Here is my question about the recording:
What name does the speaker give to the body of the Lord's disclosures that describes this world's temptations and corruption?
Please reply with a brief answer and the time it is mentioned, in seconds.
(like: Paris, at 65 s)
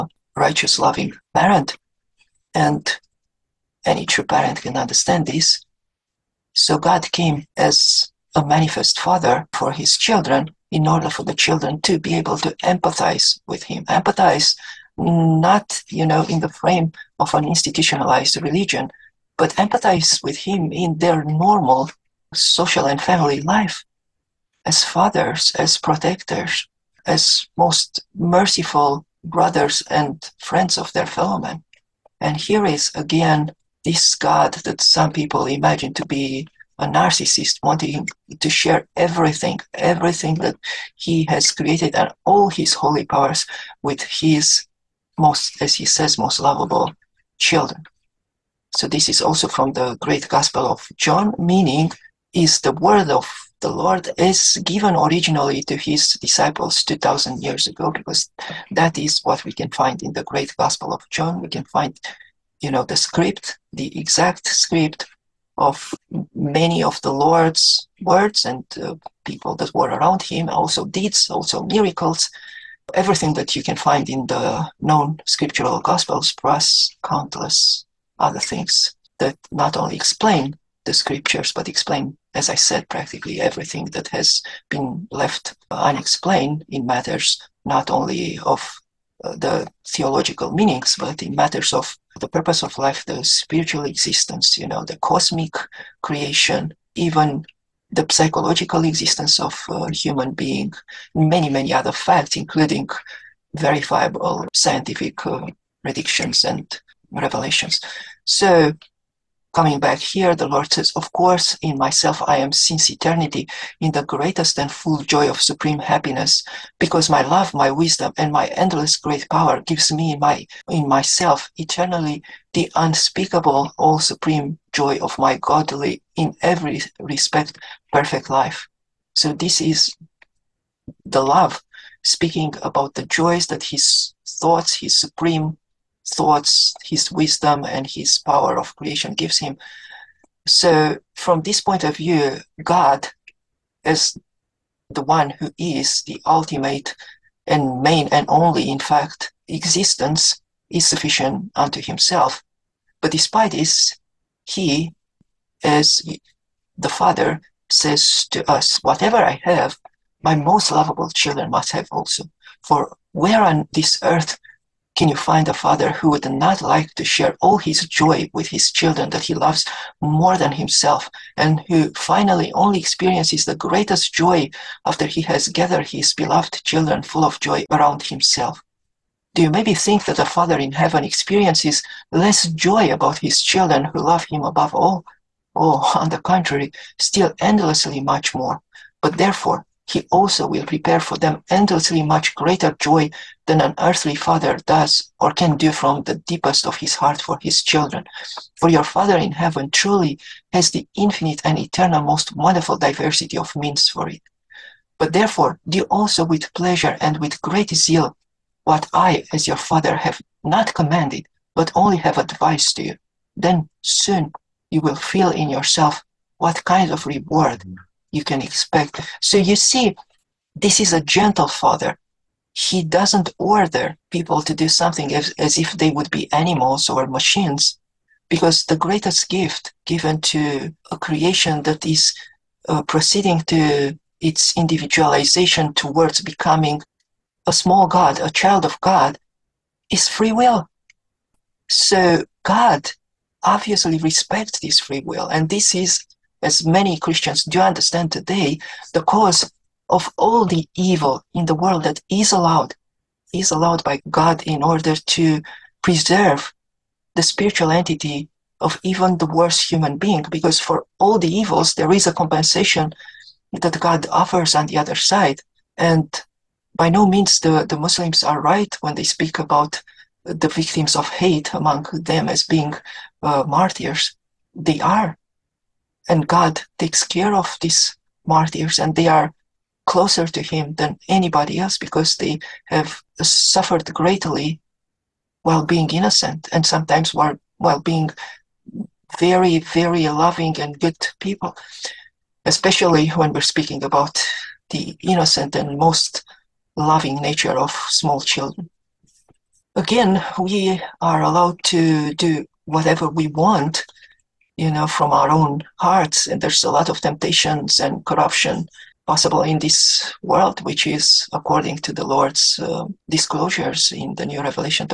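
The New Revelation, at 314 s.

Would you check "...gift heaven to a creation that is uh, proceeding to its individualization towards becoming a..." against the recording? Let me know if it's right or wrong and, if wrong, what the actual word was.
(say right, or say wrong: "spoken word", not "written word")
wrong: "given", not "heaven".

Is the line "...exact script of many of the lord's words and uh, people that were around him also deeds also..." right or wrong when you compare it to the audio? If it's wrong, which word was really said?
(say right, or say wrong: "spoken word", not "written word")
right.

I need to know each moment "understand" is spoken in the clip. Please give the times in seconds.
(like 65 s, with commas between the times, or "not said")
4 s, 247 s.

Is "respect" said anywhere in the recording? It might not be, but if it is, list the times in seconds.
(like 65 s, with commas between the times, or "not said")
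126 s, 243 s.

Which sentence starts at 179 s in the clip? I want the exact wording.
Do you maybe think that the Father in heaven experiences less joy about his children who love him above all?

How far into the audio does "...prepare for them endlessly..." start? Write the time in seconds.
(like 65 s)
190 s.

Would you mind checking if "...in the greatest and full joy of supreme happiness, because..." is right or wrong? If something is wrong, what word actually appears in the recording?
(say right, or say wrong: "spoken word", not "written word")
right.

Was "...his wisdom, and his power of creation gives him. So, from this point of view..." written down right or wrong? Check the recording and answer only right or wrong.
right.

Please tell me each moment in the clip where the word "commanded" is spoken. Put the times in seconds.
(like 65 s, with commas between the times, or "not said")
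210 s.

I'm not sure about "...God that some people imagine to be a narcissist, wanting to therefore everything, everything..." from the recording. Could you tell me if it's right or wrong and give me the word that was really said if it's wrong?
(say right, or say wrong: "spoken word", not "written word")
wrong: "share", not "therefore".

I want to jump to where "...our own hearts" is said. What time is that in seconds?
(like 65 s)
305 s.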